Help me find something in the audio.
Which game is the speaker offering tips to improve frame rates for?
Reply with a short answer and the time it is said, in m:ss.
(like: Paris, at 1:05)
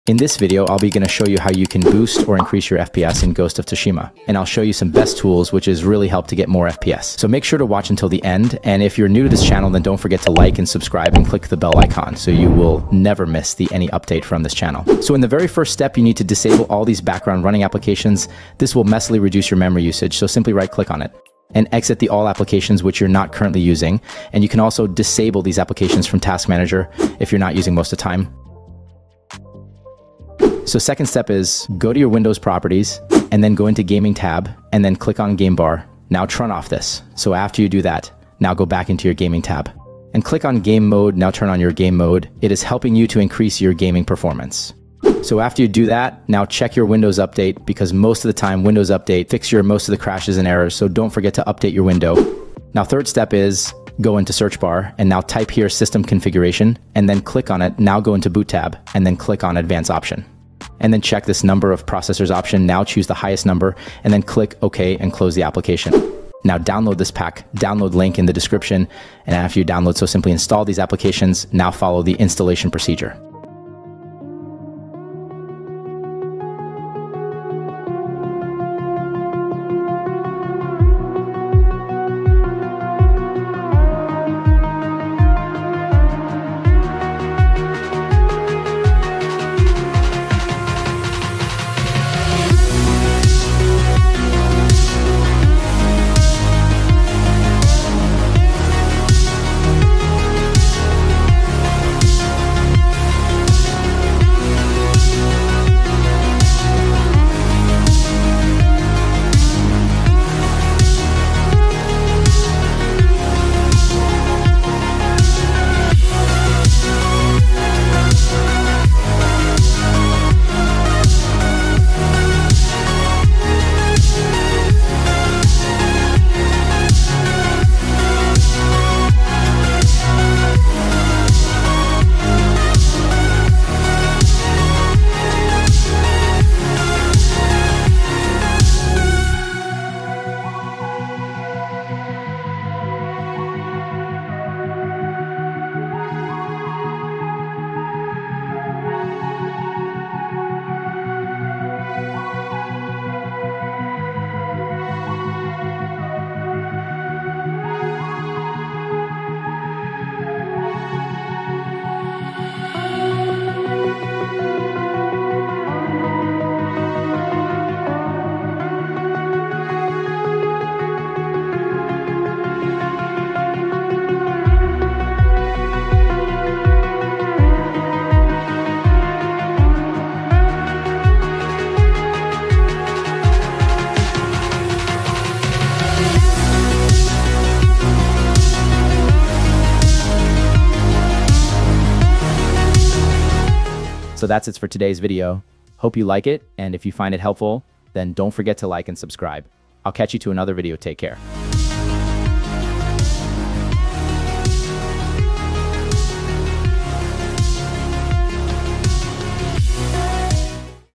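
Ghost of Tsushima, at 0:03.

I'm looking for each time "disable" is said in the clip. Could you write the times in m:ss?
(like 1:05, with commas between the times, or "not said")
0:16, 0:24.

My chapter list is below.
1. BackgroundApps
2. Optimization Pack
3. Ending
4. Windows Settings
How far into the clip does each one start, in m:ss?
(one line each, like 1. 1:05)
1. 0:14
2. 1:05
3. 3:14
4. 0:30.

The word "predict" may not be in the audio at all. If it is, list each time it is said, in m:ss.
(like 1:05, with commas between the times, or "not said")
not said.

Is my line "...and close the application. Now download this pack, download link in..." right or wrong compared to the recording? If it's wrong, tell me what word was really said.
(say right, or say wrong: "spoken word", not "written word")
right.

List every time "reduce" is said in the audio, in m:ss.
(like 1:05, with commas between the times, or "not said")
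0:19.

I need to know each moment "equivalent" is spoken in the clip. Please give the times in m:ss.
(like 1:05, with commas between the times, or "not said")
not said.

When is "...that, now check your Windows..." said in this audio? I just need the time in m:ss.
0:45.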